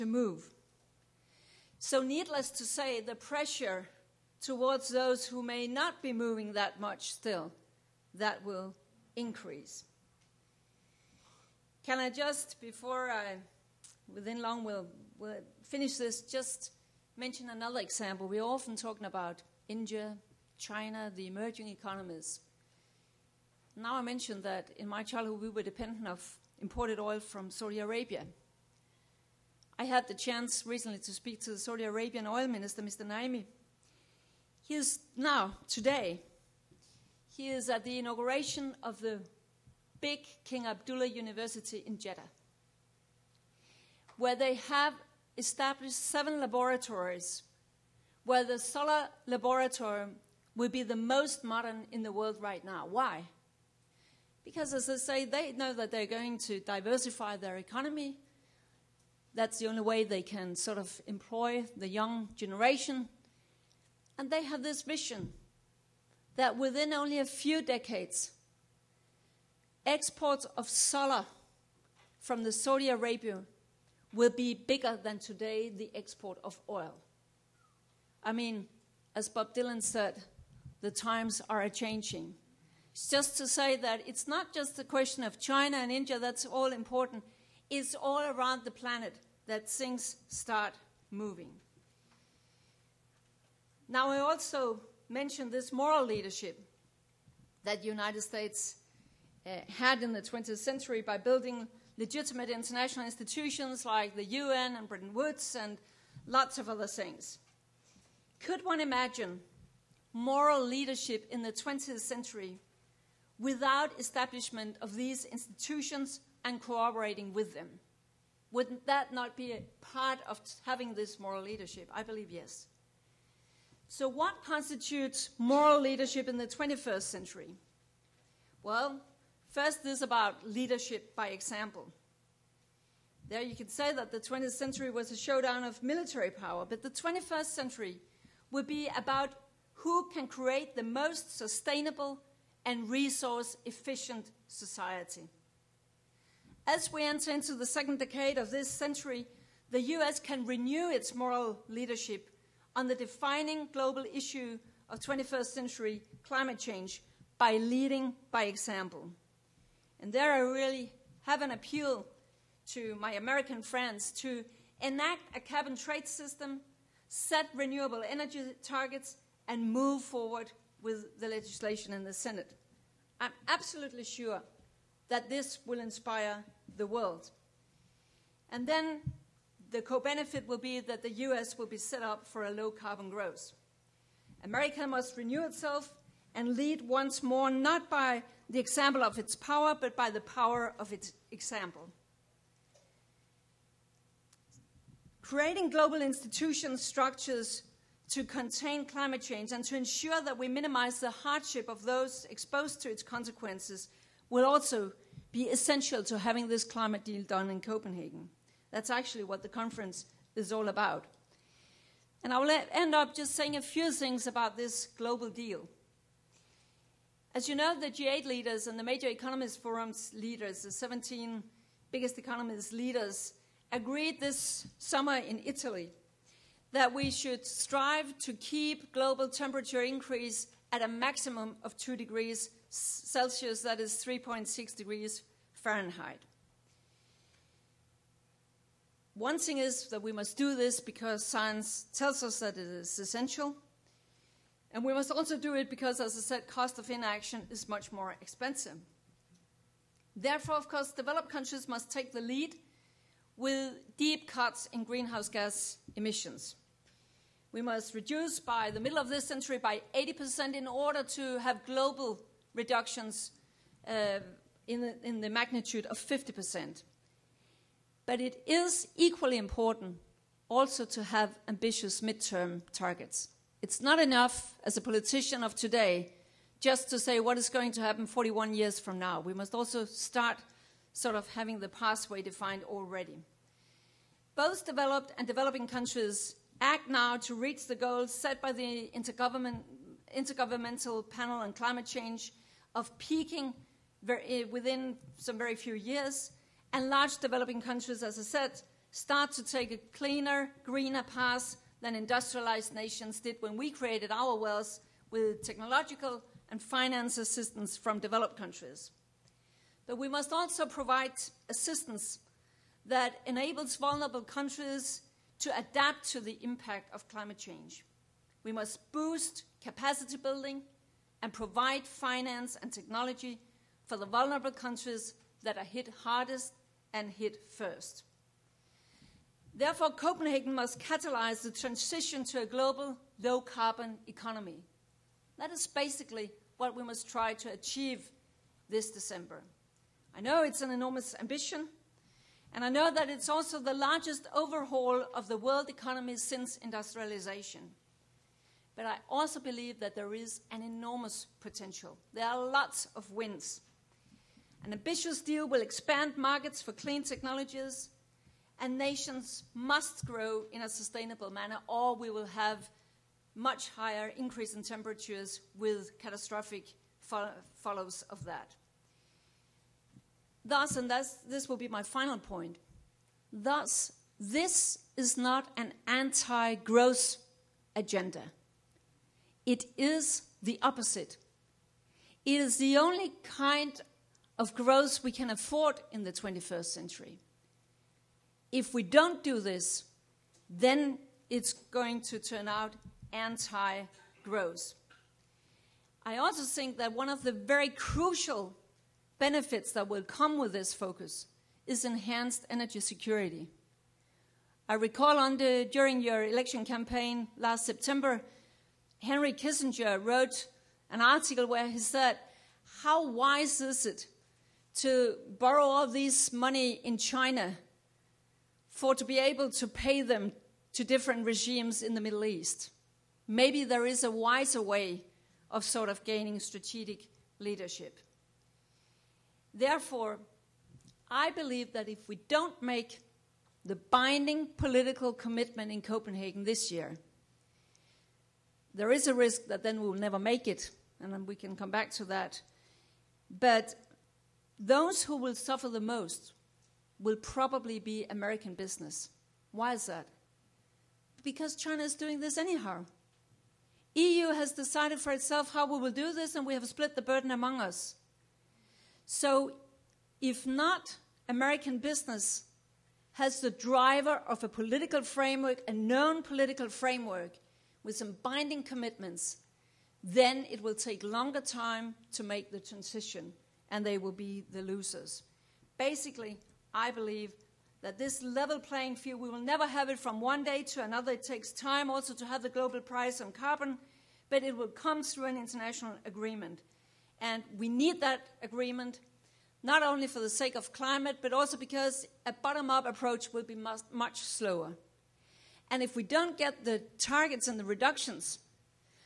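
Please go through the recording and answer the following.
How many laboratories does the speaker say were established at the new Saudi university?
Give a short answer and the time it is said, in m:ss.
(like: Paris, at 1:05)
7, at 0:46.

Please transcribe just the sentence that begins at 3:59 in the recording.
One thing is that we must do this because science tells us that it is essential.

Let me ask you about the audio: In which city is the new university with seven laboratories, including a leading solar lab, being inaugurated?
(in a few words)
Jeddah.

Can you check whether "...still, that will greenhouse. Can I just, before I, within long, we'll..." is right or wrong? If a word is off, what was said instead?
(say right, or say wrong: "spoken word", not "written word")
wrong: "increase", not "greenhouse".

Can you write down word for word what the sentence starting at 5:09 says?
But we must also provide assistance that enables vulnerable countries to adapt to the impact of climate change.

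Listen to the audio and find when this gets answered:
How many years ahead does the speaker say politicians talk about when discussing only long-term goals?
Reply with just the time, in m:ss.
4:38.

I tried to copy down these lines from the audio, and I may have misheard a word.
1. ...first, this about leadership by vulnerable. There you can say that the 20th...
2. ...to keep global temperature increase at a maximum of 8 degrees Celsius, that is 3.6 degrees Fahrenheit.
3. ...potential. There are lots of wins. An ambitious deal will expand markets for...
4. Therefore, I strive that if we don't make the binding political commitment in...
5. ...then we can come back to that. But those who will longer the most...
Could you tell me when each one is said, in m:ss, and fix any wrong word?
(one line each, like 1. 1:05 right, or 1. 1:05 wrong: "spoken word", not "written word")
1. 2:09 wrong: "example", not "vulnerable"
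2. 3:48 wrong: "2", not "8"
3. 5:51 right
4. 7:09 wrong: "believe", not "strive"
5. 7:21 wrong: "suffer", not "longer".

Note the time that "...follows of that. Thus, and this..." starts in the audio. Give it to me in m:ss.
6:07.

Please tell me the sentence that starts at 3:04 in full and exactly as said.
America must renew itself and lead once more, not by the example of its power, but by the power of its example.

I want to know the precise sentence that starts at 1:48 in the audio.
Could one imagine moral leadership in the 20th century without establishment of these institutions, and cooperating with them.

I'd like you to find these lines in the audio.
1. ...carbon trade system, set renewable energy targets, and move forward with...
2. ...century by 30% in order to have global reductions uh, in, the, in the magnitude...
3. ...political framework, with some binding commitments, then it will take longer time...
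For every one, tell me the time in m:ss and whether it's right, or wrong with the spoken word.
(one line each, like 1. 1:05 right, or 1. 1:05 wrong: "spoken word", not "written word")
1. 2:45 right
2. 4:19 wrong: "80", not "30"
3. 7:46 right.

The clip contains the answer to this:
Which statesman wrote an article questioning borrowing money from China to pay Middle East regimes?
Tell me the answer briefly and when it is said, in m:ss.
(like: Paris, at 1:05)
Henry Kissinger, at 6:49.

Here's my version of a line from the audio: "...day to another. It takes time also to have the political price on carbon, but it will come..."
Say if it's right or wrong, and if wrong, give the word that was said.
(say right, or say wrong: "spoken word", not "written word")
wrong: "global", not "political".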